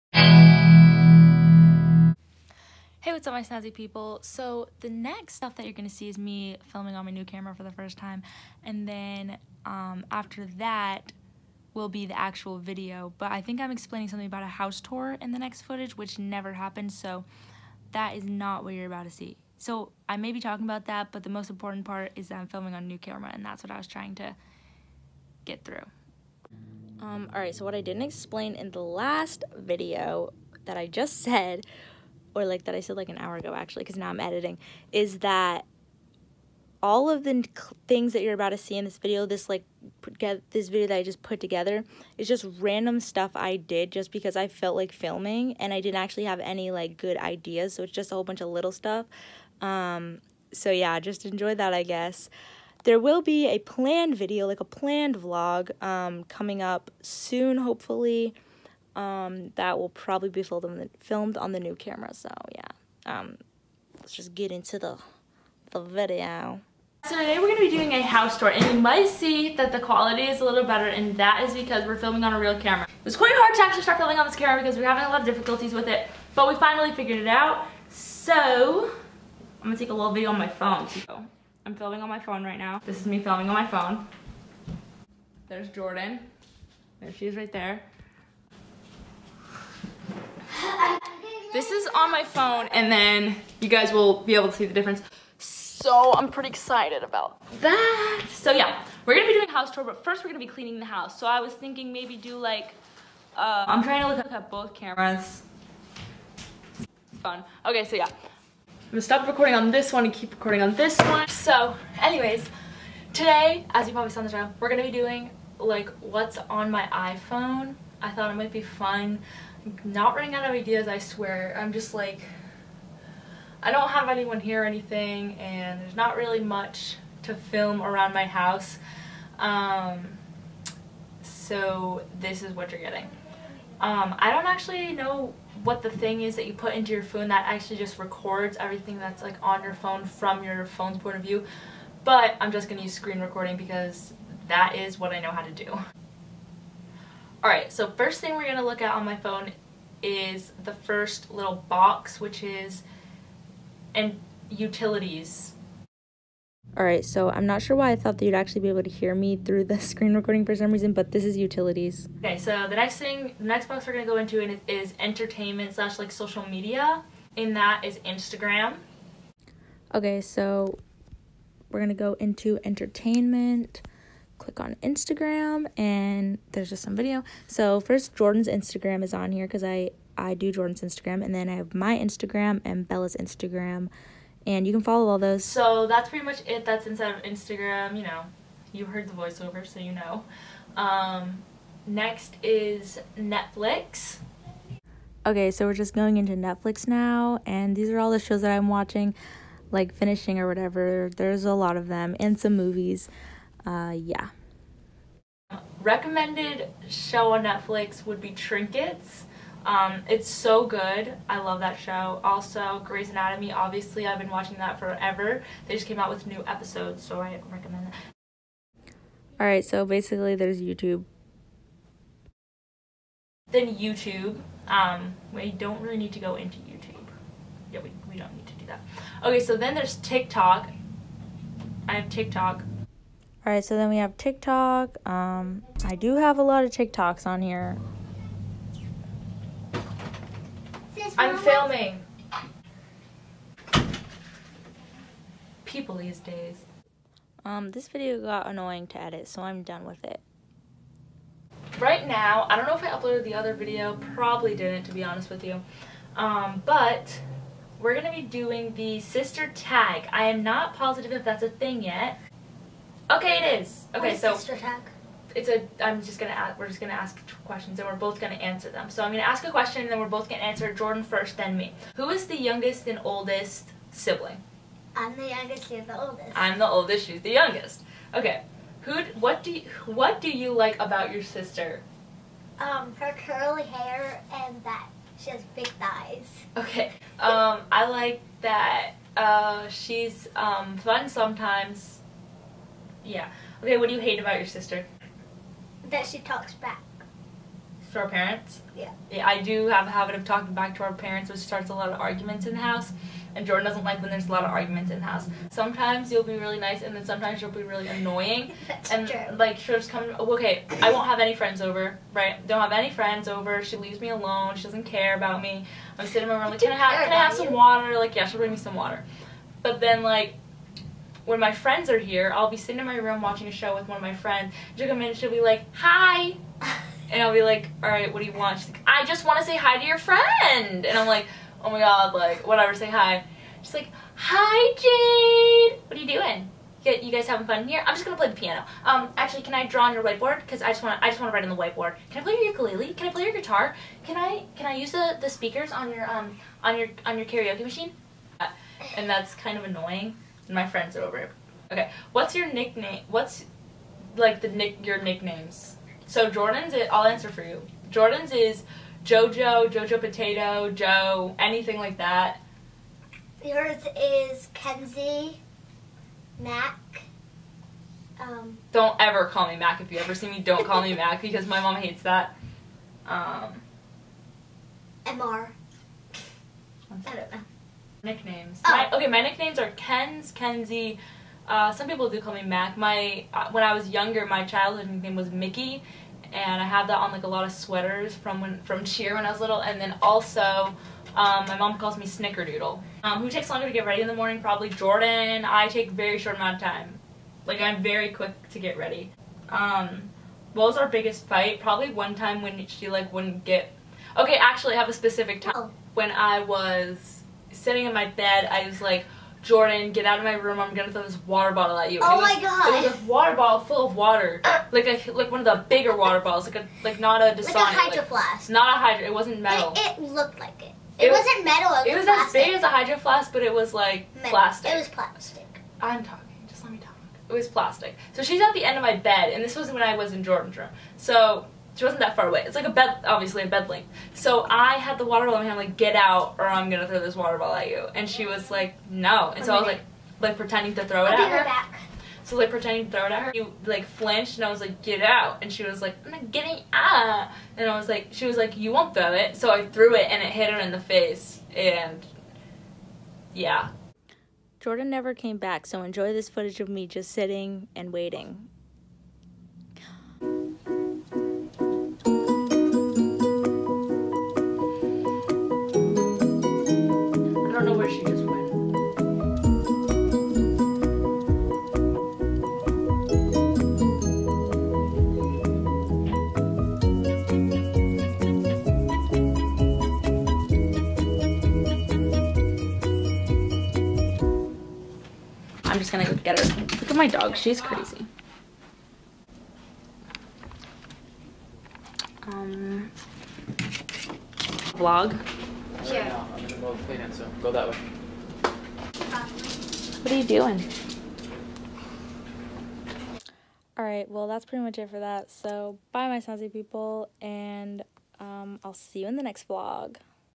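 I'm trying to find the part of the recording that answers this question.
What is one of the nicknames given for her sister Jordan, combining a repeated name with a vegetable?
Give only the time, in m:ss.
5:59.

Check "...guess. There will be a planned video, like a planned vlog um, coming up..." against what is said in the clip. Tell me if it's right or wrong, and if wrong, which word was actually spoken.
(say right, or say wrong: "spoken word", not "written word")
right.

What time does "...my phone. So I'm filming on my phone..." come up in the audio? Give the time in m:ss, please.
1:20.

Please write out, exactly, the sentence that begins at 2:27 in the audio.
Alright, so first thing we're going to look at on my phone is the first little box, which is and utilities.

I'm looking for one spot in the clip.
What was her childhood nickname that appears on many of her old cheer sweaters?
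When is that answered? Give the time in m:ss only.
6:25.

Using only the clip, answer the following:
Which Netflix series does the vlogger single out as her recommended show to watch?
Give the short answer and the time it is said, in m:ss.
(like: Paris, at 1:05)
Trinkets, at 3:28.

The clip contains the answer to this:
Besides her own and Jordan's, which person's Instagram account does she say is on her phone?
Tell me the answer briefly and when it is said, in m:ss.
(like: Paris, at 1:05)
Bella's, at 3:02.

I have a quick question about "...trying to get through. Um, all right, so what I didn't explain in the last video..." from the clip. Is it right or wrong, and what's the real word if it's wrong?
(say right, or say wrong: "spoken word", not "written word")
right.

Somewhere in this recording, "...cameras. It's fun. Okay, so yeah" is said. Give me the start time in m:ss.
1:44.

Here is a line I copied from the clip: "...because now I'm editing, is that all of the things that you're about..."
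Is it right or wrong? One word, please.
right.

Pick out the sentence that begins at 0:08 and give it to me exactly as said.
And then um, after that will be the actual video.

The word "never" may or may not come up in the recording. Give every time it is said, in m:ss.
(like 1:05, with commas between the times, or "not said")
0:16, 7:34.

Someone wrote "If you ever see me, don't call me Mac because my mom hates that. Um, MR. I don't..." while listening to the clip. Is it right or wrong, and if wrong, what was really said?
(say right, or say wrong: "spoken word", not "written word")
right.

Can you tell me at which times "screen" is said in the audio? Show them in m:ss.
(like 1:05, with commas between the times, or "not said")
2:22, 2:39.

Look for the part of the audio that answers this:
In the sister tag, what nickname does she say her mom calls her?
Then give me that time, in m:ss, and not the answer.
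6:32.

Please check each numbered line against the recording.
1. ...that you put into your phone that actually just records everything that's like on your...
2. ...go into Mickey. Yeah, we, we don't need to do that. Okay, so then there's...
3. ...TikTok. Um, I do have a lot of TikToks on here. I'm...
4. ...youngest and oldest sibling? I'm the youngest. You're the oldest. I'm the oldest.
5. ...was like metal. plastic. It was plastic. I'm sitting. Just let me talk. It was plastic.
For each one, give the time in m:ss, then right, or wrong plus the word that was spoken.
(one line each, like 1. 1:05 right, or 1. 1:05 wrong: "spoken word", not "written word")
1. 2:16 right
2. 3:46 wrong: "YouTube", not "Mickey"
3. 3:54 right
4. 4:32 right
5. 7:03 wrong: "talking", not "sitting".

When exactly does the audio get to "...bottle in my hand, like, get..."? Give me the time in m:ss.
7:15.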